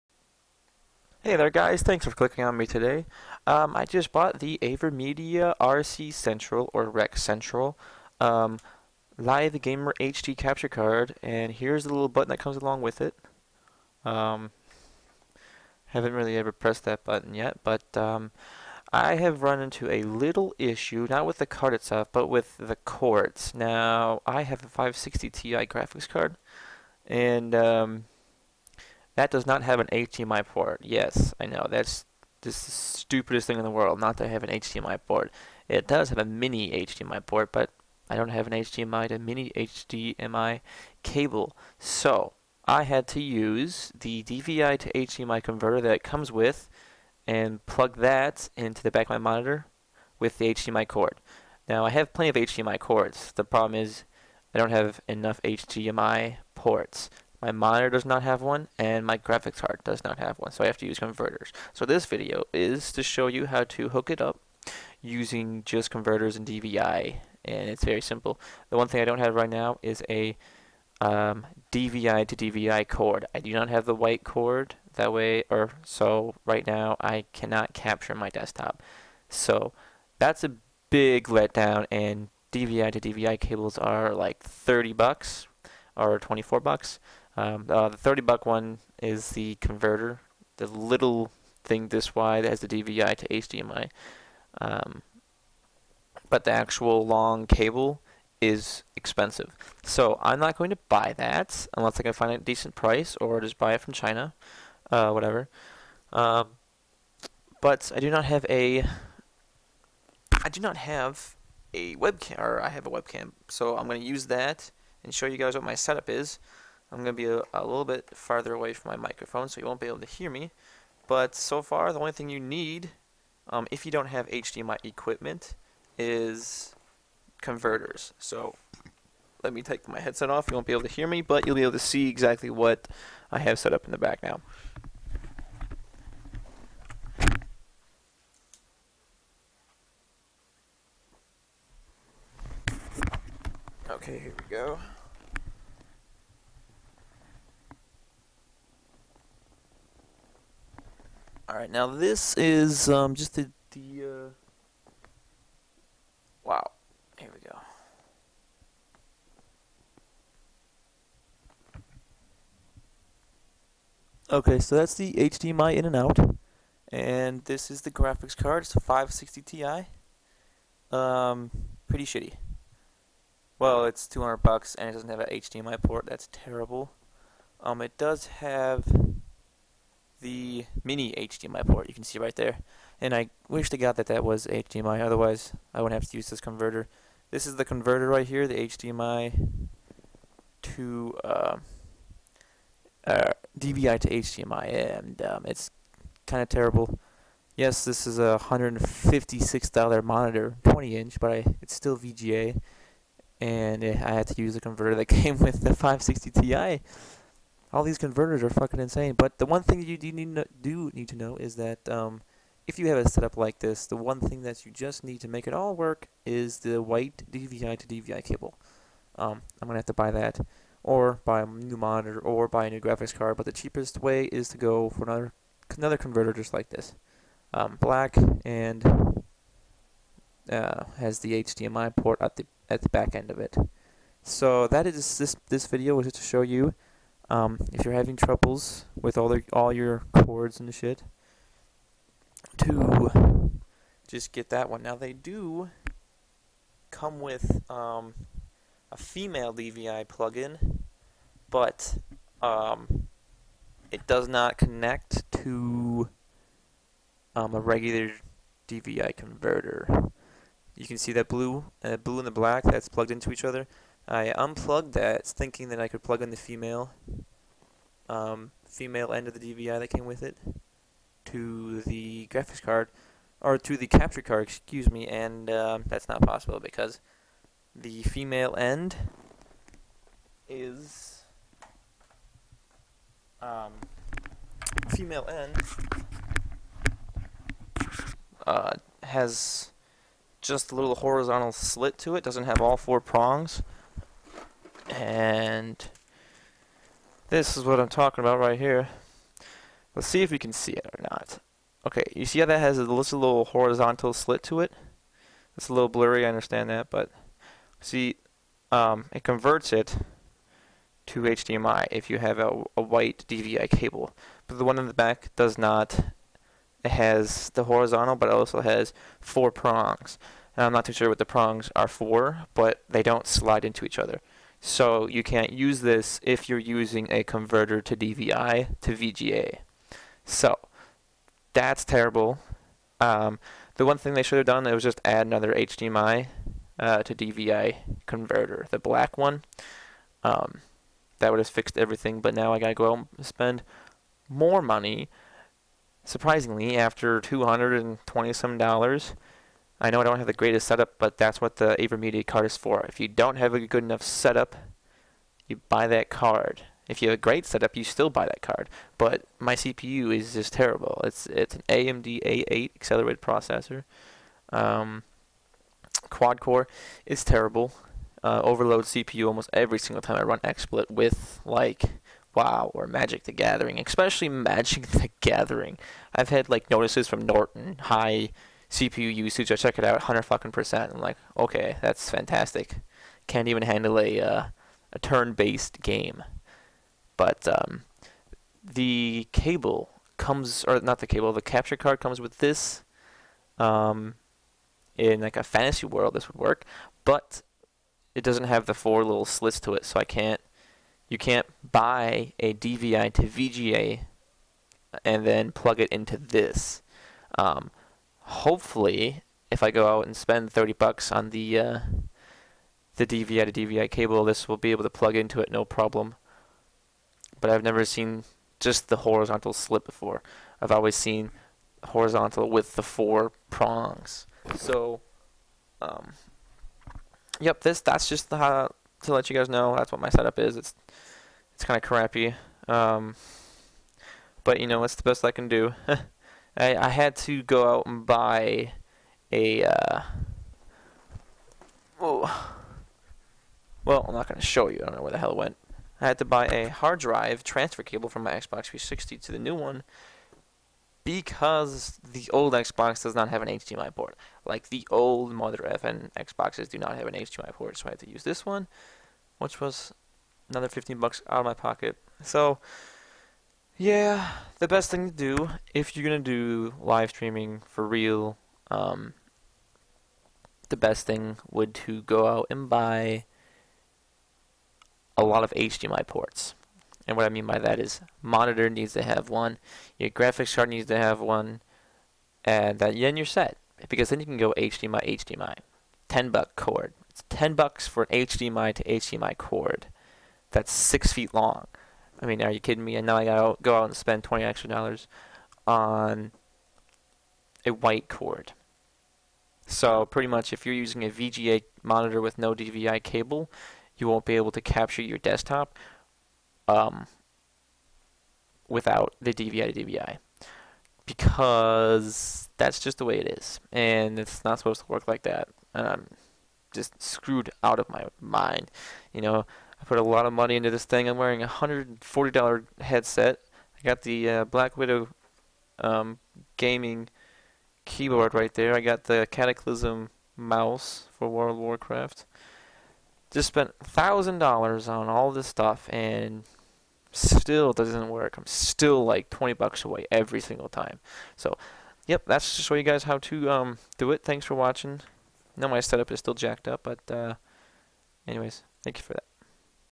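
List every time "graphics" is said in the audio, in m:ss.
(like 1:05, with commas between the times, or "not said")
0:25, 0:59, 2:47, 3:42, 4:32, 8:00.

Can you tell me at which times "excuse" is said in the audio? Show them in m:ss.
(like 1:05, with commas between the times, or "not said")
4:34.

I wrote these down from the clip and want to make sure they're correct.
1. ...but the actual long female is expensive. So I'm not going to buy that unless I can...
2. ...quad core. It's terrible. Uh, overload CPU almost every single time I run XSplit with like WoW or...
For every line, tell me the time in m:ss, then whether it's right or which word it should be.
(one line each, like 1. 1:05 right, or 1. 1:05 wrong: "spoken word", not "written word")
1. 1:36 wrong: "cable", not "female"
2. 6:06 right.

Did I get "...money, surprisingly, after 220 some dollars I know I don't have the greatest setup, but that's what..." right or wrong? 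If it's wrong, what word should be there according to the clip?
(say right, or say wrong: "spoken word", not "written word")
right.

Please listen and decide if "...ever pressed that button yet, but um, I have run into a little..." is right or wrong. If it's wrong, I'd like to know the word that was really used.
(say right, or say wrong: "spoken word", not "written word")
right.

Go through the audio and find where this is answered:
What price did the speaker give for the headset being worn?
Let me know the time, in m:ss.
8:41.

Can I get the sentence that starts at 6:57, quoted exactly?
But I've never seen just the horizontal slip before.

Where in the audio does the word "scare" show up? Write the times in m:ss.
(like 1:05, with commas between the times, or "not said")
not said.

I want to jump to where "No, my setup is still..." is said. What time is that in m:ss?
9:05.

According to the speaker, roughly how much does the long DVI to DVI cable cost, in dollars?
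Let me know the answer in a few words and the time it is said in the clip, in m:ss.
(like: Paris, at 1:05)
$24, at 1:26.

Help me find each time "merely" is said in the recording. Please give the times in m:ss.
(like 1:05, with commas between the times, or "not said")
not said.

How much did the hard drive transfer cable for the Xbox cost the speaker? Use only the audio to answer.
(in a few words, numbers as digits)
$15.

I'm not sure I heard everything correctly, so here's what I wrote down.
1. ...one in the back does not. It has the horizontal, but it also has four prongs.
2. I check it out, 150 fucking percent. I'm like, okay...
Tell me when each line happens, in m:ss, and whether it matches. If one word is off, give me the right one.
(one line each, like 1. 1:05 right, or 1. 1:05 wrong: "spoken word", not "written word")
1. 5:14 right
2. 6:19 wrong: "100", not "150".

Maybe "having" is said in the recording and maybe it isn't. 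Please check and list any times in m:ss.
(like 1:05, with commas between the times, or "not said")
3:57.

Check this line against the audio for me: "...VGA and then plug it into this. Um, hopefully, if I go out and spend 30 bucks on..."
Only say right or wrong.
right.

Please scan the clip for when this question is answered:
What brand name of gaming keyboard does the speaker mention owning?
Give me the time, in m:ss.
8:44.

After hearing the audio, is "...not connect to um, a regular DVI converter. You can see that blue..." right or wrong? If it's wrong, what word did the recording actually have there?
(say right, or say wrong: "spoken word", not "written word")
right.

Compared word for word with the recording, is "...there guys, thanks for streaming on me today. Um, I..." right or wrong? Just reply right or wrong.
wrong.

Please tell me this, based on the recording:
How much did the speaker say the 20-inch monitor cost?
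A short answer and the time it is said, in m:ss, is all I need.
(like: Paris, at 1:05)
$156, at 3:18.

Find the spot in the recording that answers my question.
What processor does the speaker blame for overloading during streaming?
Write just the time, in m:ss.
6:01.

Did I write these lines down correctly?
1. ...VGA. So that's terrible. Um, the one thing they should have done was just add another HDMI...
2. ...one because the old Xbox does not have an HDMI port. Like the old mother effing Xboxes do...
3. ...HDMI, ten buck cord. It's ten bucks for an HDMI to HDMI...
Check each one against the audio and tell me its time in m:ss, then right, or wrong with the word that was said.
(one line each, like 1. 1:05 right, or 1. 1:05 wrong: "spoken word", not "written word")
1. 5:28 right
2. 7:29 right
3. 8:05 right.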